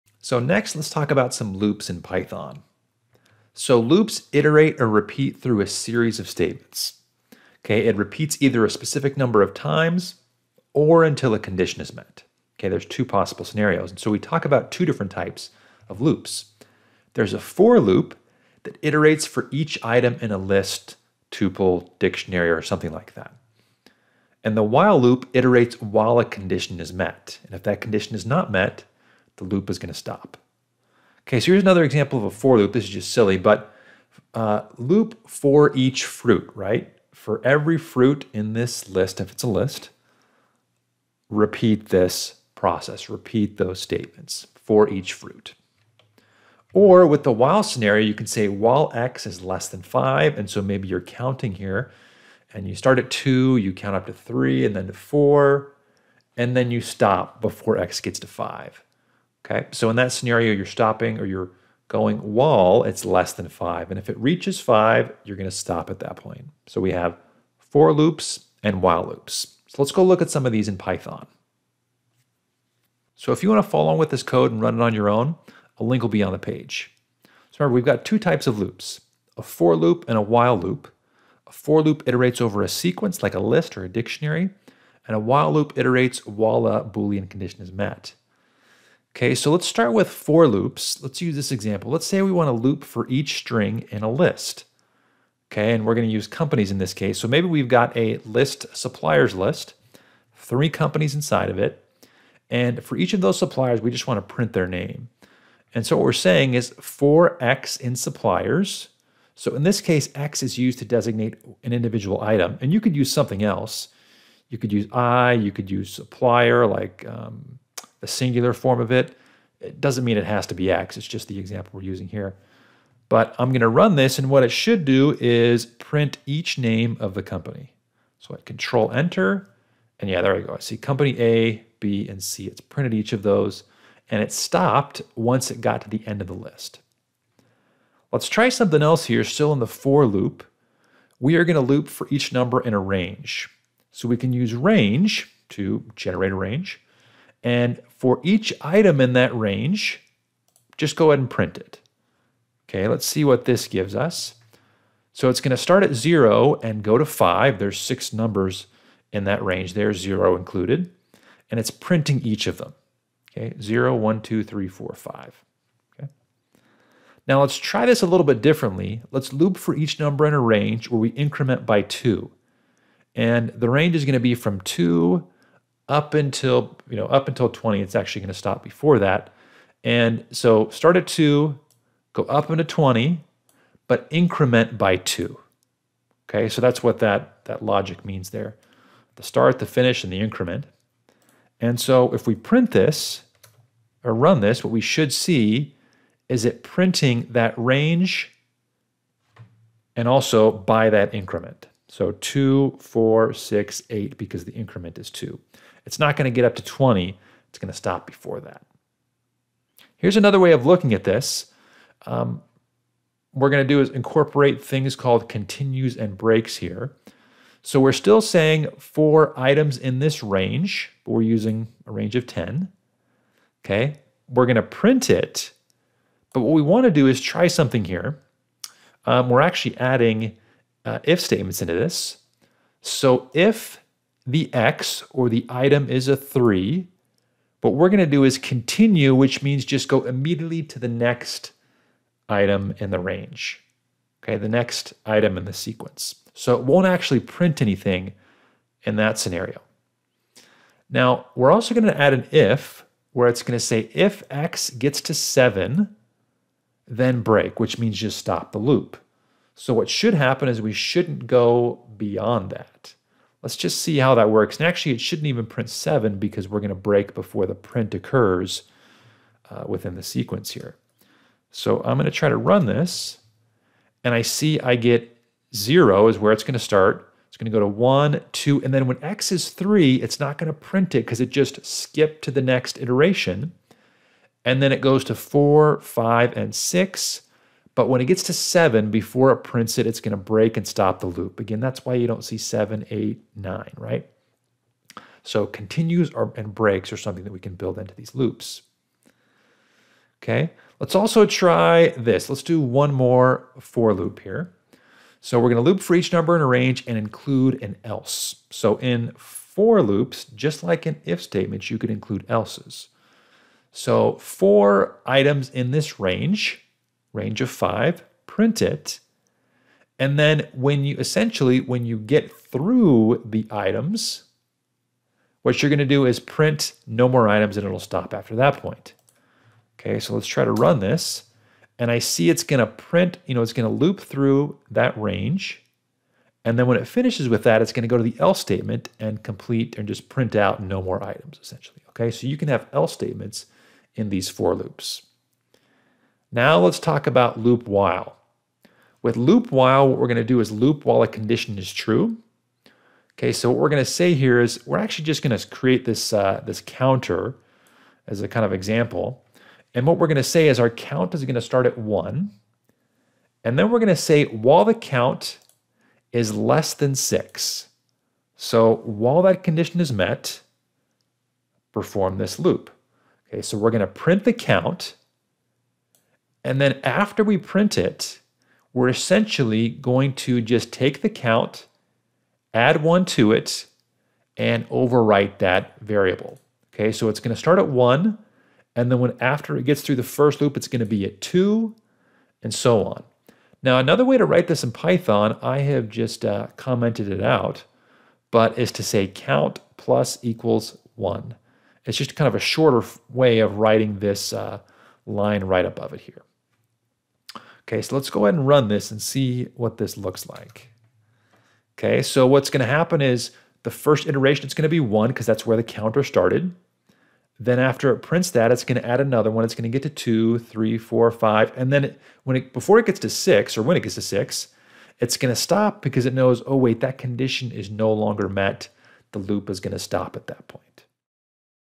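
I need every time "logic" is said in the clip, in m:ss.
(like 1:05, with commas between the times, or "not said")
3:07.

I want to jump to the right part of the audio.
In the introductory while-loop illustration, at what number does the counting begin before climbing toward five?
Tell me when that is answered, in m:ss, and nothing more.
0:52.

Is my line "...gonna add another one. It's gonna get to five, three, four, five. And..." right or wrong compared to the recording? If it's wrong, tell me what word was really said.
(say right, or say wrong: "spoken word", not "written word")
wrong: "two", not "five".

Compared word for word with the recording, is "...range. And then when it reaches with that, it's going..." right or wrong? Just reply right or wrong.
wrong.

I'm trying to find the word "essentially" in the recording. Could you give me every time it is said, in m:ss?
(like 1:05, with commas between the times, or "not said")
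5:20, 5:41, 6:18.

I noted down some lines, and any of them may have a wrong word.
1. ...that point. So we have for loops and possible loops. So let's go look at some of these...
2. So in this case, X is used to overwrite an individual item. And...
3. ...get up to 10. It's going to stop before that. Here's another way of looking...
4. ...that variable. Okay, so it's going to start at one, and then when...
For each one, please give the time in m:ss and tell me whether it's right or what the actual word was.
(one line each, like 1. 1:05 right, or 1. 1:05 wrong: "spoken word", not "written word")
1. 1:05 wrong: "while", not "possible"
2. 1:49 wrong: "designate", not "overwrite"
3. 3:26 wrong: "20", not "10"
4. 6:25 right.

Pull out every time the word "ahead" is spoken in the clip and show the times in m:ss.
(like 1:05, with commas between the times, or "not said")
2:31, 6:48.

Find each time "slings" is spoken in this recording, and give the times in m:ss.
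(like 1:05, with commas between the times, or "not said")
not said.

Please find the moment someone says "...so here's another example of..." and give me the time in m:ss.
0:31.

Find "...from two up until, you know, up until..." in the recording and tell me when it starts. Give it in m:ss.
2:54.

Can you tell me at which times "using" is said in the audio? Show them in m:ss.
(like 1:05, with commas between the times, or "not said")
2:01, 3:41.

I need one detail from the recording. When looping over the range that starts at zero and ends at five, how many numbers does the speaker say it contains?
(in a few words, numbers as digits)
6.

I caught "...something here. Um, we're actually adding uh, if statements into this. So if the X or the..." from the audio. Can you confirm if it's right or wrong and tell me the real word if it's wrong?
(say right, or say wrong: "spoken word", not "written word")
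right.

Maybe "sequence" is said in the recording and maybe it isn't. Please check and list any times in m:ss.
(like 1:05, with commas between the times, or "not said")
1:22, 4:05, 4:30.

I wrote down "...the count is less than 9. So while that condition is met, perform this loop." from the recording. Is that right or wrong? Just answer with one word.
wrong.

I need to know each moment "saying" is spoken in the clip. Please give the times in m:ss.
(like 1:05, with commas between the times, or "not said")
1:46, 3:38.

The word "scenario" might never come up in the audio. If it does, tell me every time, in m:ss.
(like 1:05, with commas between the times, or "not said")
0:13, 0:47, 1:00, 4:09.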